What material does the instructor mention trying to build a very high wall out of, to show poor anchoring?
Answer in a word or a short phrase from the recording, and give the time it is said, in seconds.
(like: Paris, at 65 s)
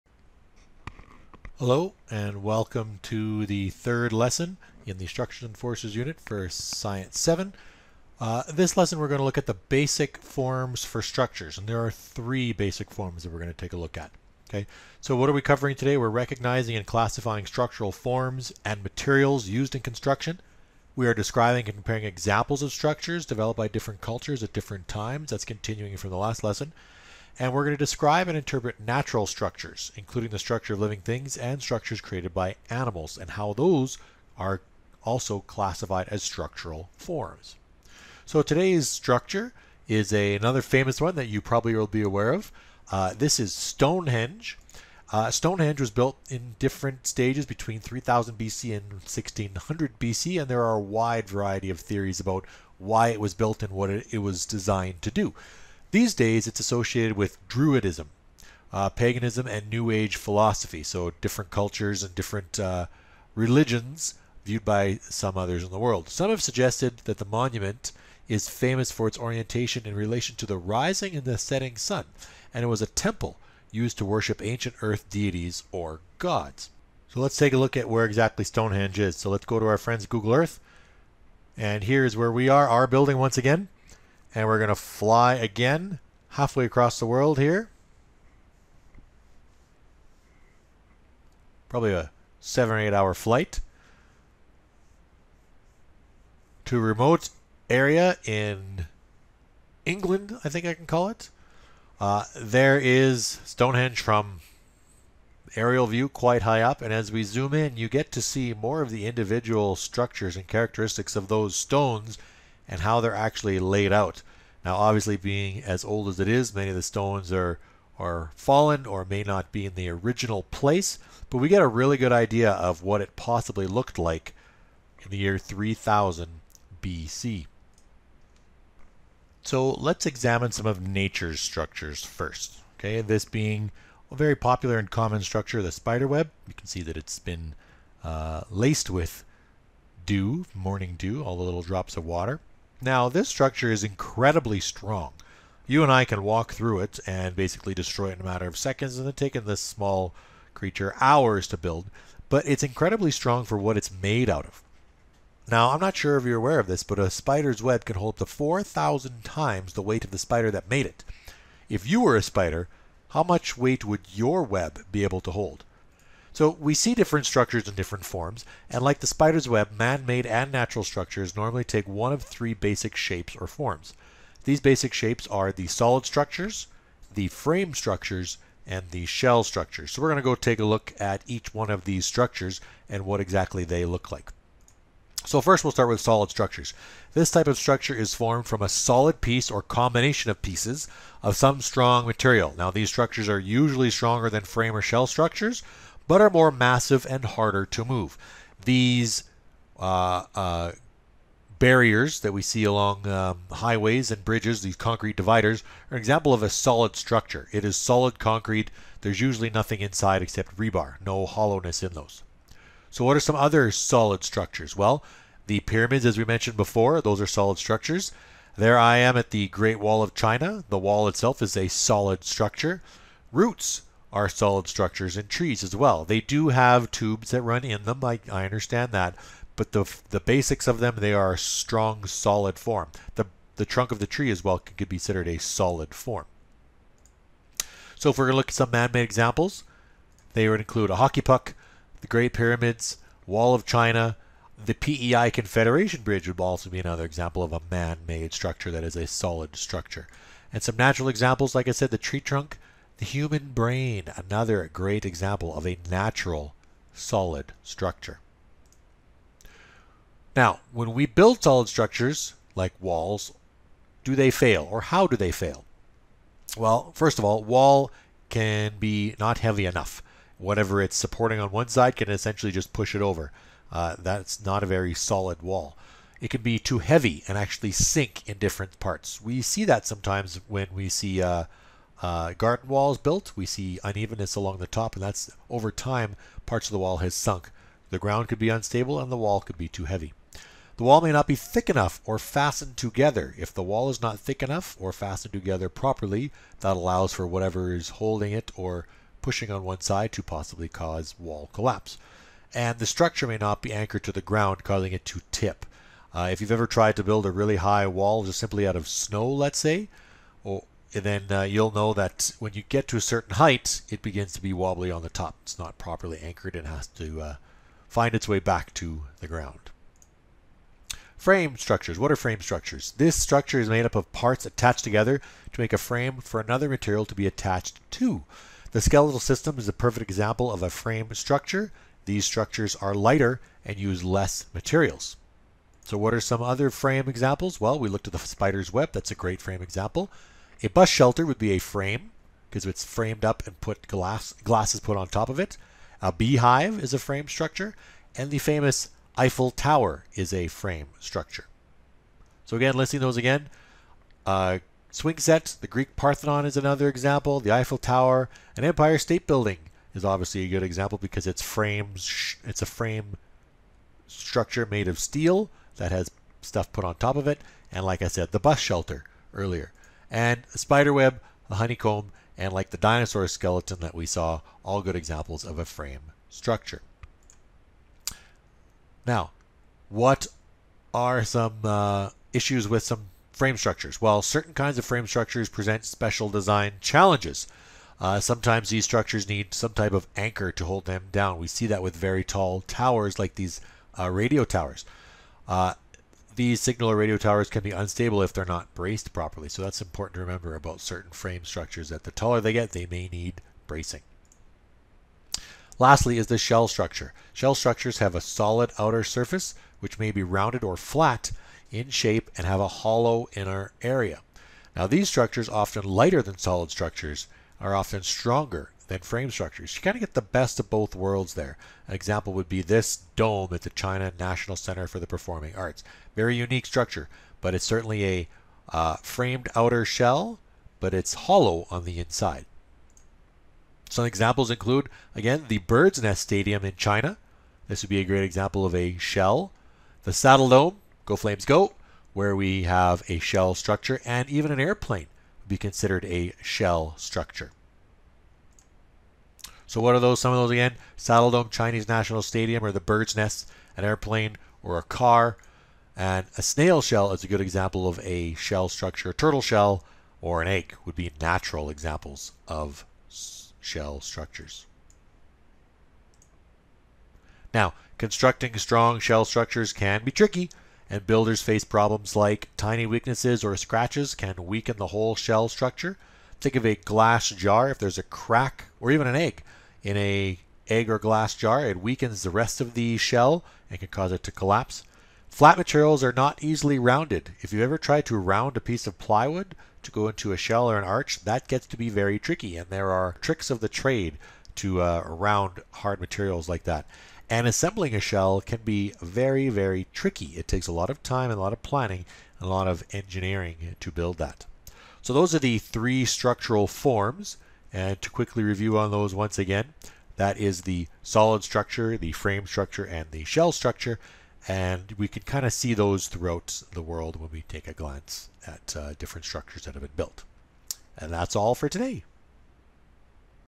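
snow, at 308 s.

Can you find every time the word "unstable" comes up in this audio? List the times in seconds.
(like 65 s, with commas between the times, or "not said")
288 s, 397 s.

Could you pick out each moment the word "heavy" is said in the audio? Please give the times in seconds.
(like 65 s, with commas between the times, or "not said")
269 s, 276 s, 289 s.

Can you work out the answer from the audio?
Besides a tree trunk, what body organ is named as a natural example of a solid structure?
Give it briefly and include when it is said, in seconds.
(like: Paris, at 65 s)
human brain, at 253 s.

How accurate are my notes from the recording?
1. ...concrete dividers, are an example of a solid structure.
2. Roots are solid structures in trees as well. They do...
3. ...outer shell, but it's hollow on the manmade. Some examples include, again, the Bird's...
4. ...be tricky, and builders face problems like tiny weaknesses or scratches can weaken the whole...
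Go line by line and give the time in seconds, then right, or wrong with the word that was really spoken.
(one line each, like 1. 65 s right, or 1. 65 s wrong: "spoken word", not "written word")
1. 204 s right
2. 223 s right
3. 429 s wrong: "inside", not "manmade"
4. 470 s right.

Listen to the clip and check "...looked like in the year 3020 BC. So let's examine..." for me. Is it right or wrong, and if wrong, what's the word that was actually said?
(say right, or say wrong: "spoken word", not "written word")
wrong: "3000", not "3020".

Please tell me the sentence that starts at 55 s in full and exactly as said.
These days, it's associated with Druidism, uh, paganism, and New Age philosophy.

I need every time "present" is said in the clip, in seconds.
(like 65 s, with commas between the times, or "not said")
385 s.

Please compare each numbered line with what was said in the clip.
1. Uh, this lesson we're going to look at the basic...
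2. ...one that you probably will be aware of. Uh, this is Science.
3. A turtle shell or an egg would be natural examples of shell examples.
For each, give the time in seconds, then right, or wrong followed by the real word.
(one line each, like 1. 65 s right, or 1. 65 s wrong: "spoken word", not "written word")
1. 8 s right
2. 41 s wrong: "Stonehenge", not "Science"
3. 459 s wrong: "structures", not "examples".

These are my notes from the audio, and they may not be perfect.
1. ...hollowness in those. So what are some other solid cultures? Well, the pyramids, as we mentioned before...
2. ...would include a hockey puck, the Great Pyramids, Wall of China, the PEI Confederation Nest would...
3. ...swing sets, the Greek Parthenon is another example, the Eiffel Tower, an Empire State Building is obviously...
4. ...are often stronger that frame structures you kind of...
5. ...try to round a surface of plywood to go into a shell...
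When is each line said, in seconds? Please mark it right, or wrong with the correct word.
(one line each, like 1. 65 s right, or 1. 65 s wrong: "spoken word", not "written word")
1. 211 s wrong: "structures", not "cultures"
2. 240 s wrong: "Bridge", not "Nest"
3. 354 s right
4. 417 s right
5. 487 s wrong: "piece", not "surface".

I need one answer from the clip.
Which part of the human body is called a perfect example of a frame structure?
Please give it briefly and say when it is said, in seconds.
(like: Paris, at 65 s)
skeletal system, at 328 s.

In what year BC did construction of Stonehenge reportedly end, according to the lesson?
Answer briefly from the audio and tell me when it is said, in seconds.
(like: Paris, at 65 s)
1600 BC, at 48 s.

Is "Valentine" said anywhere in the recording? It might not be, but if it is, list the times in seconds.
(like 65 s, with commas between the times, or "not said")
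not said.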